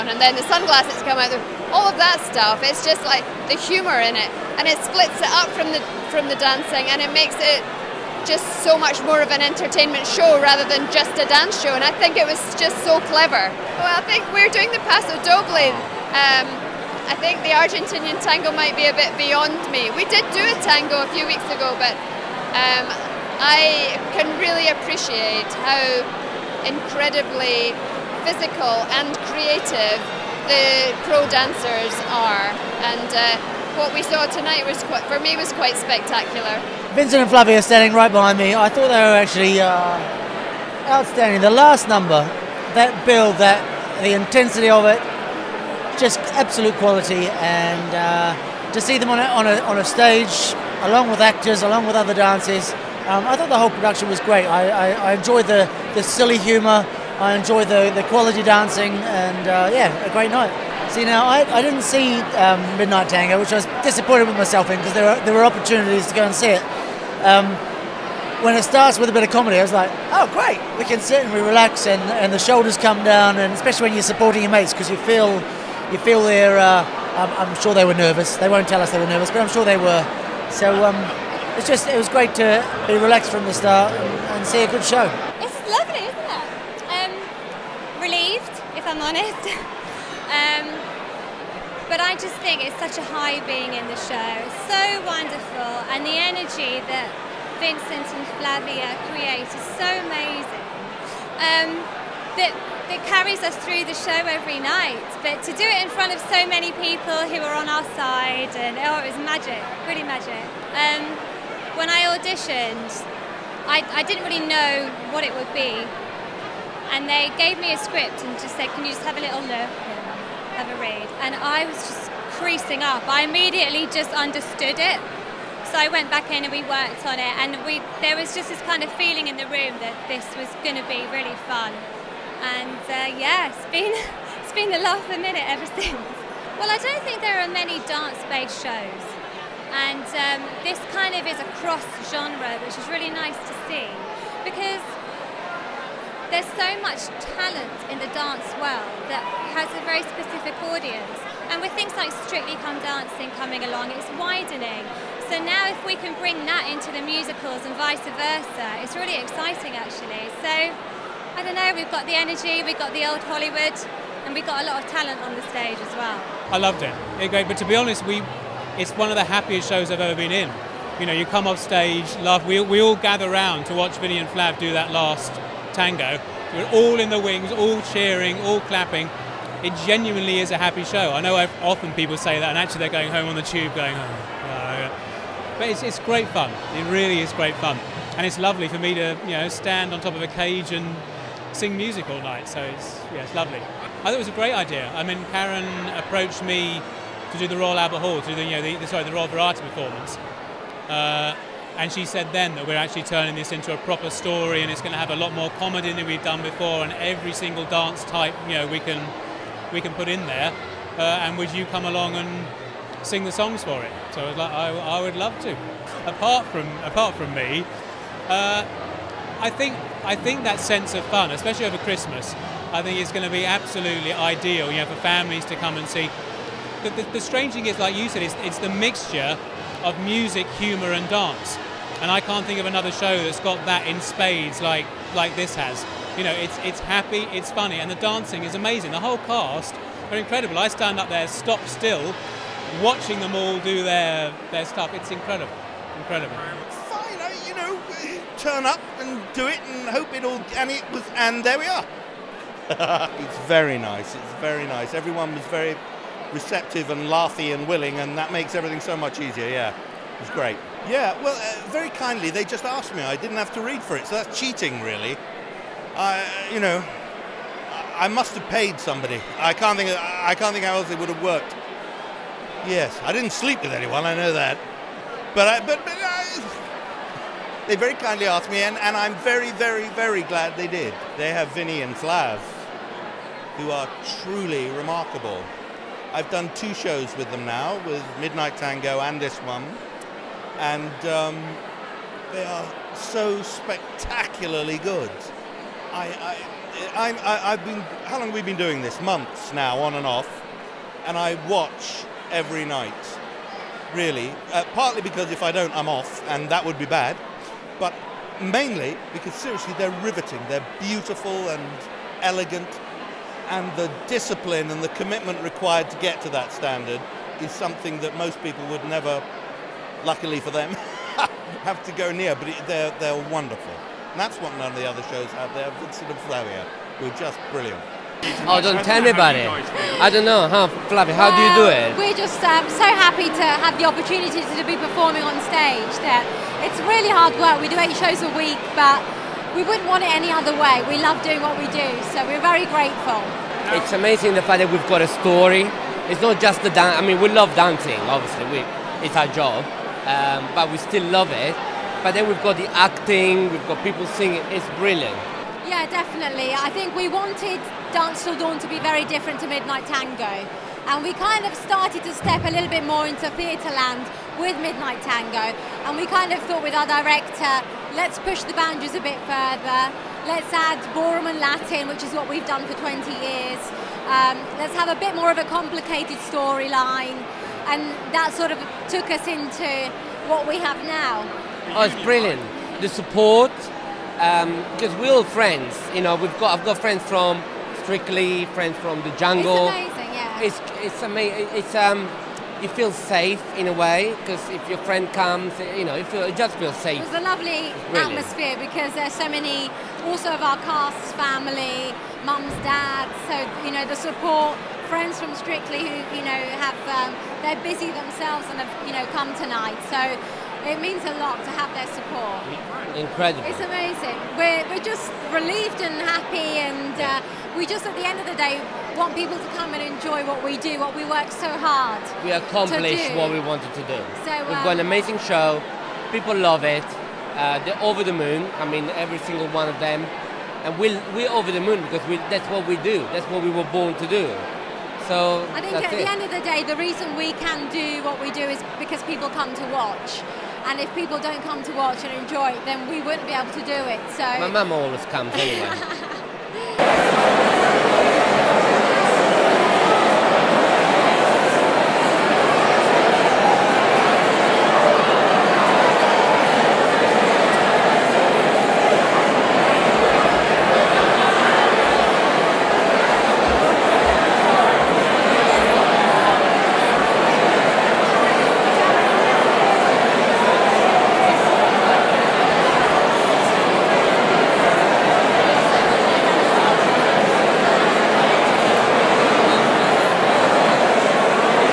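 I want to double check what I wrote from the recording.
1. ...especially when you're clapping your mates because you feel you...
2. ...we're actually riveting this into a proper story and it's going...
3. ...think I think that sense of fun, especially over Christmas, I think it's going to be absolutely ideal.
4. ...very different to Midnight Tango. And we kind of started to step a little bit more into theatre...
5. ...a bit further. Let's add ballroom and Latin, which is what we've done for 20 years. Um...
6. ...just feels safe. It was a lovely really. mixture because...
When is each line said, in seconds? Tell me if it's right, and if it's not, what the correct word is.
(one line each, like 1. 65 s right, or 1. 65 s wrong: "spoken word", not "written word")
1. 73 s wrong: "supporting", not "clapping"
2. 202 s wrong: "turning", not "riveting"
3. 219 s right
4. 358 s right
5. 368 s right
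6. 396 s wrong: "atmosphere", not "mixture".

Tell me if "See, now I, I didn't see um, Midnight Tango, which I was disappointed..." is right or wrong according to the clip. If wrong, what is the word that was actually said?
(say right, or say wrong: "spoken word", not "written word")
right.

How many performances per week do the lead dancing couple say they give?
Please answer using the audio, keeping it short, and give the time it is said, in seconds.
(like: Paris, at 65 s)
8, at 337 s.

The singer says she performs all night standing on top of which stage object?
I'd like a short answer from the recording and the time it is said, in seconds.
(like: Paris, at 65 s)
A cage, at 190 s.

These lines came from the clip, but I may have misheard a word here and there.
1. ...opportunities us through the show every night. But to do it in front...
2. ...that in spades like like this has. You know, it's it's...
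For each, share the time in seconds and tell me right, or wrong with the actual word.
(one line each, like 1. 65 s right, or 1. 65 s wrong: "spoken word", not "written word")
1. 103 s wrong: "carries", not "opportunities"
2. 233 s right.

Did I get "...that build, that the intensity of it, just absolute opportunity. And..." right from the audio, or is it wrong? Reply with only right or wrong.
wrong.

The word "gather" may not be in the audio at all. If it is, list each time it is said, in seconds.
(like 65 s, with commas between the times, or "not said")
172 s.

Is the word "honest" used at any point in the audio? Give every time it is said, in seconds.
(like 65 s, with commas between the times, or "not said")
89 s, 167 s.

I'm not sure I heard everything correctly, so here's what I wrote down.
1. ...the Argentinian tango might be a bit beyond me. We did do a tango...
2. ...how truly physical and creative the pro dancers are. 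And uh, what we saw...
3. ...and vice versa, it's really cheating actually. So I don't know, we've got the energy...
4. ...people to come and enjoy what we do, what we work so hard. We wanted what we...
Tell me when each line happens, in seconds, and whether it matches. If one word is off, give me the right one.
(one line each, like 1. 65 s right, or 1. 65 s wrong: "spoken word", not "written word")
1. 17 s right
2. 25 s wrong: "incredibly", not "truly"
3. 157 s wrong: "exciting", not "cheating"
4. 419 s wrong: "accomplished", not "wanted".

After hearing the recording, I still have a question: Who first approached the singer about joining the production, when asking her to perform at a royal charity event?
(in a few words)
Karen.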